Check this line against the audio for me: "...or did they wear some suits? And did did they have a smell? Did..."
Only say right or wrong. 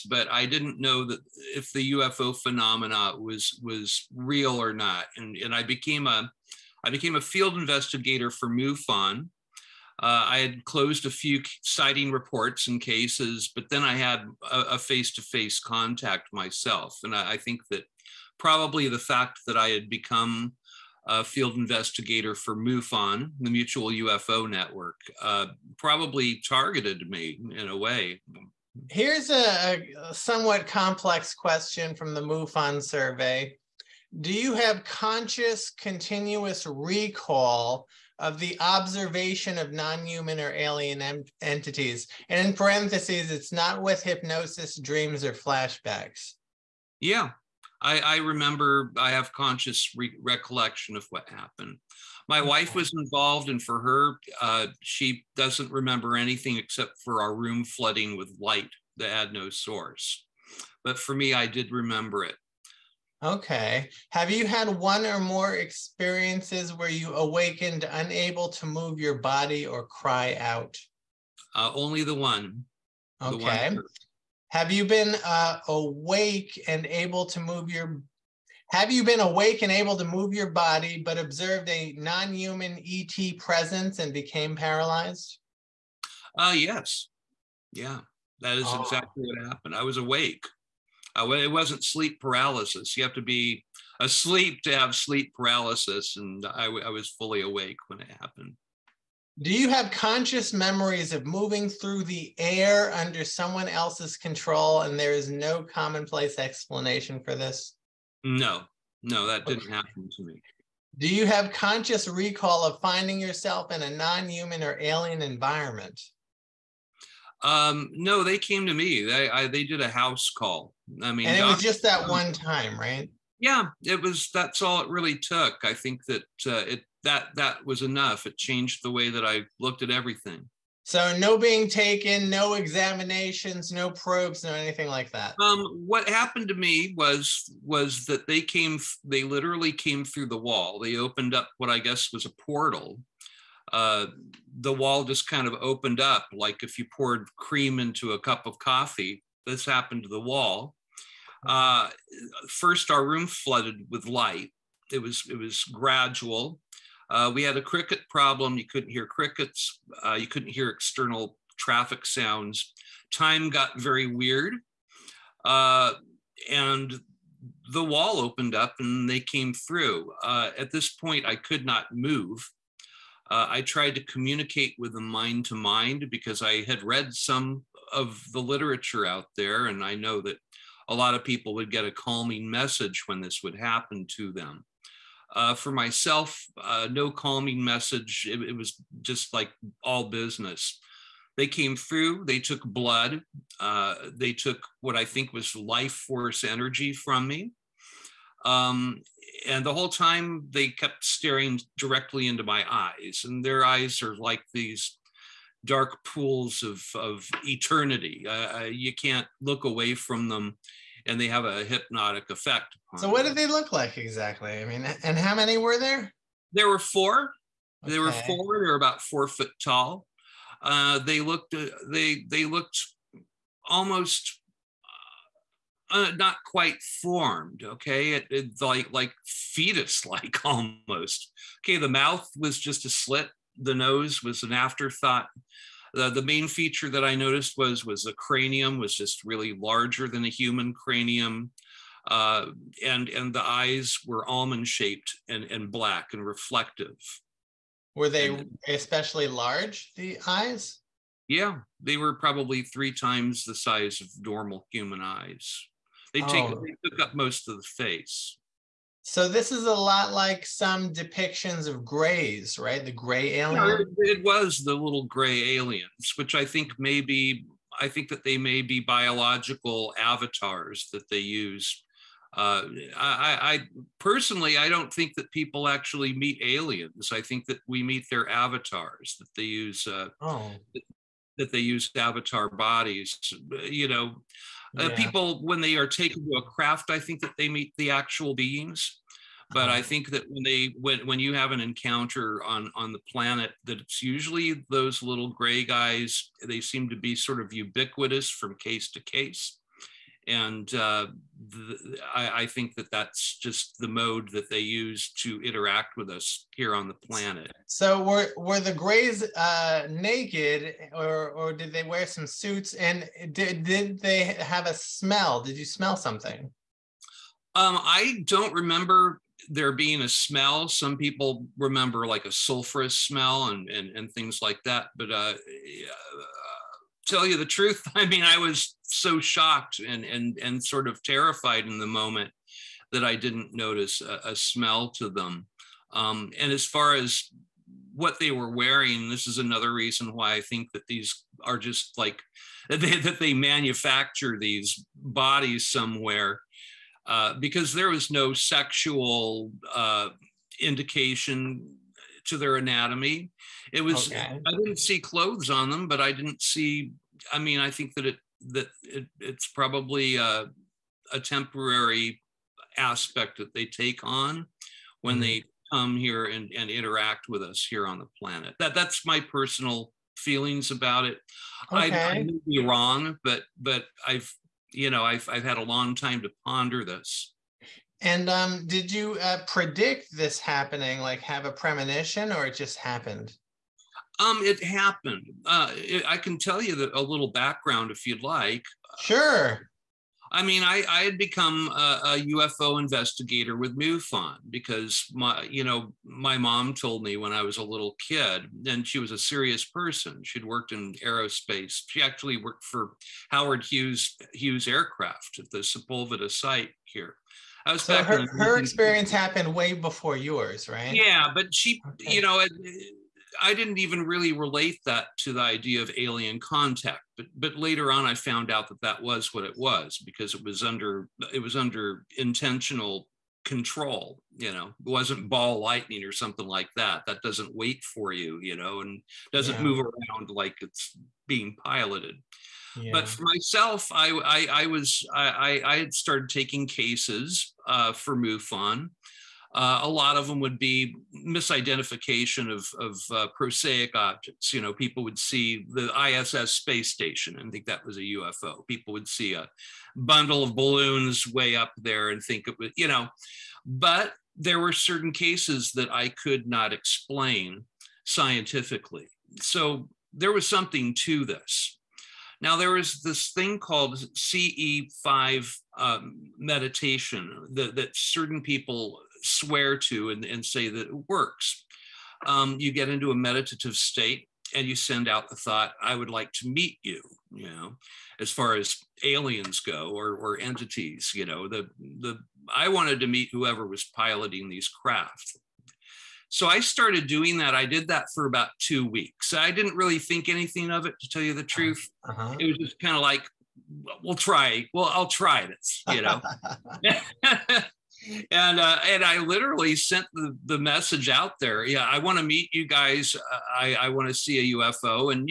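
right.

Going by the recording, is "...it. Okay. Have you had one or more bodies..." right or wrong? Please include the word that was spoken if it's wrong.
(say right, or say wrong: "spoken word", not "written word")
wrong: "experiences", not "bodies".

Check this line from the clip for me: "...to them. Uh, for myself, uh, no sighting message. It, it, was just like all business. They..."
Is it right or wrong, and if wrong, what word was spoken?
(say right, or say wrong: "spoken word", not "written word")
wrong: "calming", not "sighting".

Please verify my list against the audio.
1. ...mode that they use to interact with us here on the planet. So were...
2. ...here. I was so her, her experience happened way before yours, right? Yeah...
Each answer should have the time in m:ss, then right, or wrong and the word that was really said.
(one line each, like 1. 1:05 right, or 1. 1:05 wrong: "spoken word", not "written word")
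1. 5:03 right
2. 6:46 right.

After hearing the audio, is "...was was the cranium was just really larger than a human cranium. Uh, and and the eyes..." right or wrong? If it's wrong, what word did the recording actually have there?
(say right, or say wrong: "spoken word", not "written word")
right.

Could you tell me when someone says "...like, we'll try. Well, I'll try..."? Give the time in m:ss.
8:13.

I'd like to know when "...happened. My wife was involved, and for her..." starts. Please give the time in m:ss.
0:51.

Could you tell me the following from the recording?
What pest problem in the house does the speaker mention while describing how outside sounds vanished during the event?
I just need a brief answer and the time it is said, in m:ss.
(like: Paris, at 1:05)
crickets, at 2:37.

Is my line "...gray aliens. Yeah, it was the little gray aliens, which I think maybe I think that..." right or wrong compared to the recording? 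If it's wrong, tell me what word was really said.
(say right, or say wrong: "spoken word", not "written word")
right.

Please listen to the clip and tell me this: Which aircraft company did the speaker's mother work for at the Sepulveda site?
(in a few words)
Hughes Aircraft.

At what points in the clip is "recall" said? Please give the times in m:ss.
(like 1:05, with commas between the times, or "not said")
0:36, 1:52.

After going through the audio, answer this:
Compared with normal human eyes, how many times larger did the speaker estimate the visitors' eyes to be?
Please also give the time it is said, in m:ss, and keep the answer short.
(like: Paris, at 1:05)
3 times, at 4:12.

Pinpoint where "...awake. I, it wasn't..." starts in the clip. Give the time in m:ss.
1:29.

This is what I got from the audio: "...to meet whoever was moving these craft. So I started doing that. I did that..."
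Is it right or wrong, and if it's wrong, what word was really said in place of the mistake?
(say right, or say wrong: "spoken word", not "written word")
wrong: "piloting", not "moving".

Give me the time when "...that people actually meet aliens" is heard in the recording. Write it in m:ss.
4:35.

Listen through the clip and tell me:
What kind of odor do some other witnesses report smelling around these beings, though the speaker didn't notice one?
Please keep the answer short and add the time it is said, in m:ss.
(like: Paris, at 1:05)
sulfurous smell, at 5:22.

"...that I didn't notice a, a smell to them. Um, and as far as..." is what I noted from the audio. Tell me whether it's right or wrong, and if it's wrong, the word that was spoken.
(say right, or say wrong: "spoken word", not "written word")
right.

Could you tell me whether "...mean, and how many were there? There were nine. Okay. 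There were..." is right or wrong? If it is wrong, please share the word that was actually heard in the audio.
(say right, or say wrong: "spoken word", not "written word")
wrong: "four", not "nine".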